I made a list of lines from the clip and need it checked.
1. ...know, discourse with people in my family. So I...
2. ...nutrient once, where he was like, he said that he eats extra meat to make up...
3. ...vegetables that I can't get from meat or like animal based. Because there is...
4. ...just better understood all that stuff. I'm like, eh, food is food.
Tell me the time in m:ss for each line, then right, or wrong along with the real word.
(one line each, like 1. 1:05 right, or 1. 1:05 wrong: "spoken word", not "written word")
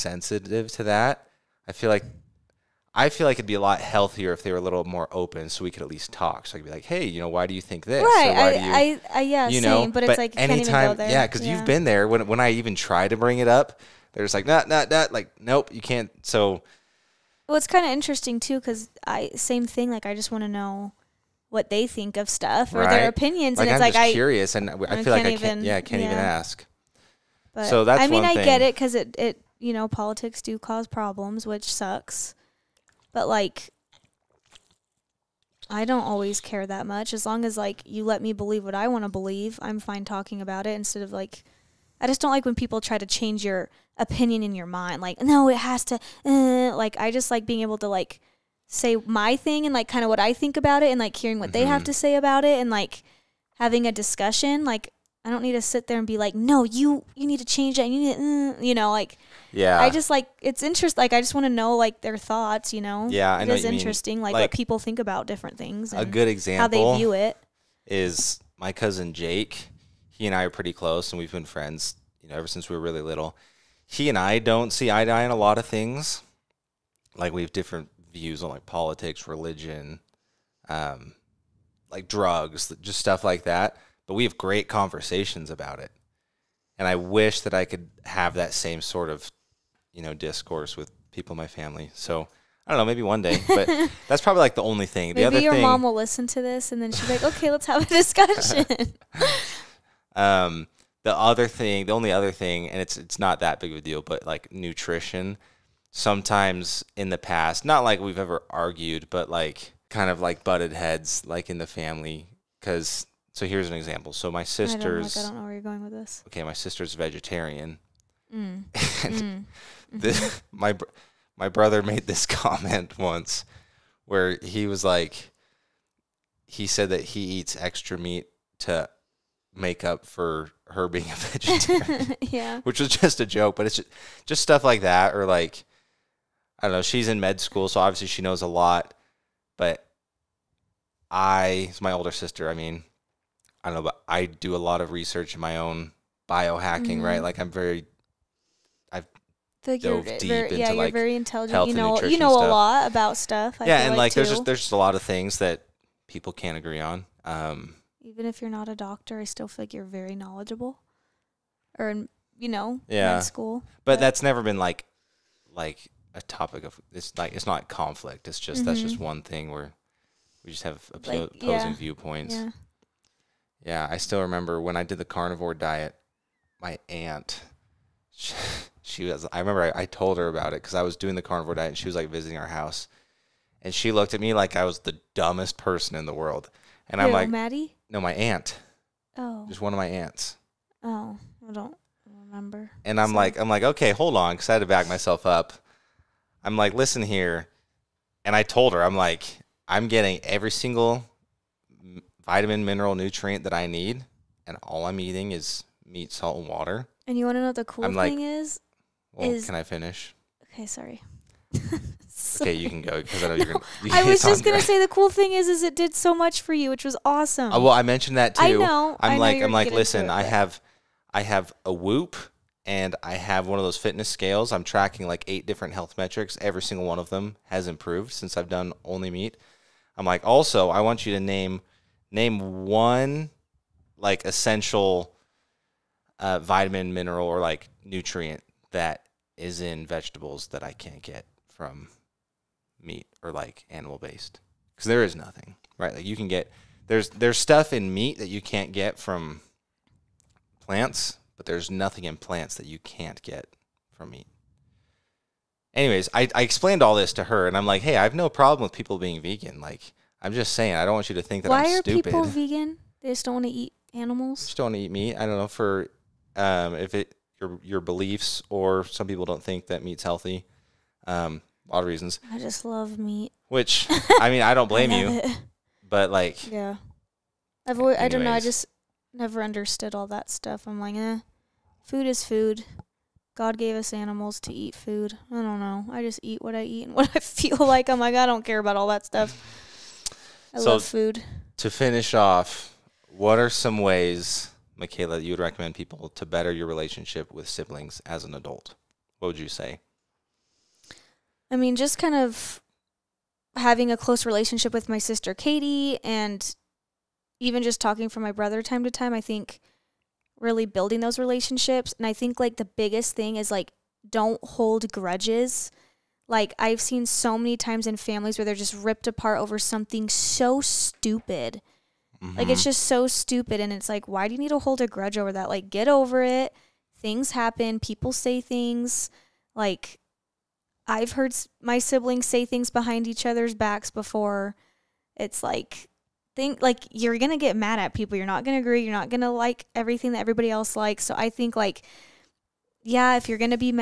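1. 1:30 right
2. 2:02 wrong: "comment", not "nutrient"
3. 3:59 right
4. 4:38 wrong: "never", not "better".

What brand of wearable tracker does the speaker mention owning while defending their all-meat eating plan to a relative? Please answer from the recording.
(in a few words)
Whoop.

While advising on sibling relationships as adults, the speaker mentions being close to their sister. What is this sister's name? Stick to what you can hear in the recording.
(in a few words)
Katie.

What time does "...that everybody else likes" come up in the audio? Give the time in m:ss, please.
5:40.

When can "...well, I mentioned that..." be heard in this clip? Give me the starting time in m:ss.
3:37.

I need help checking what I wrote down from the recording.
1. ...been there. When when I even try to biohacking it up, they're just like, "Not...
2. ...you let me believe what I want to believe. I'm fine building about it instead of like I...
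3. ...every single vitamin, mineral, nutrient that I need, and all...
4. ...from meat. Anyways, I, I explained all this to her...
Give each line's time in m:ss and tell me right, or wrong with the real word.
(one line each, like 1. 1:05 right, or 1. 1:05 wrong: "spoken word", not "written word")
1. 0:11 wrong: "bring", not "biohacking"
2. 0:37 wrong: "talking", not "building"
3. 3:20 right
4. 4:13 right.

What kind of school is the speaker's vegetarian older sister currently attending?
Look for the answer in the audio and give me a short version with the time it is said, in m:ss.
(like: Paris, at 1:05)
Med school, at 2:17.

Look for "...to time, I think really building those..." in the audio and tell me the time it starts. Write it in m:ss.
5:08.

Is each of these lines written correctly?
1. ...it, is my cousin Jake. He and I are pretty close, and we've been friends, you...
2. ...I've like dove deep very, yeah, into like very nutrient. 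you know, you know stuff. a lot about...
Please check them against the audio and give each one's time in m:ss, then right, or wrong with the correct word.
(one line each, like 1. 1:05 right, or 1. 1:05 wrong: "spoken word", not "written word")
1. 1:07 right
2. 2:28 wrong: "intelligent", not "nutrient".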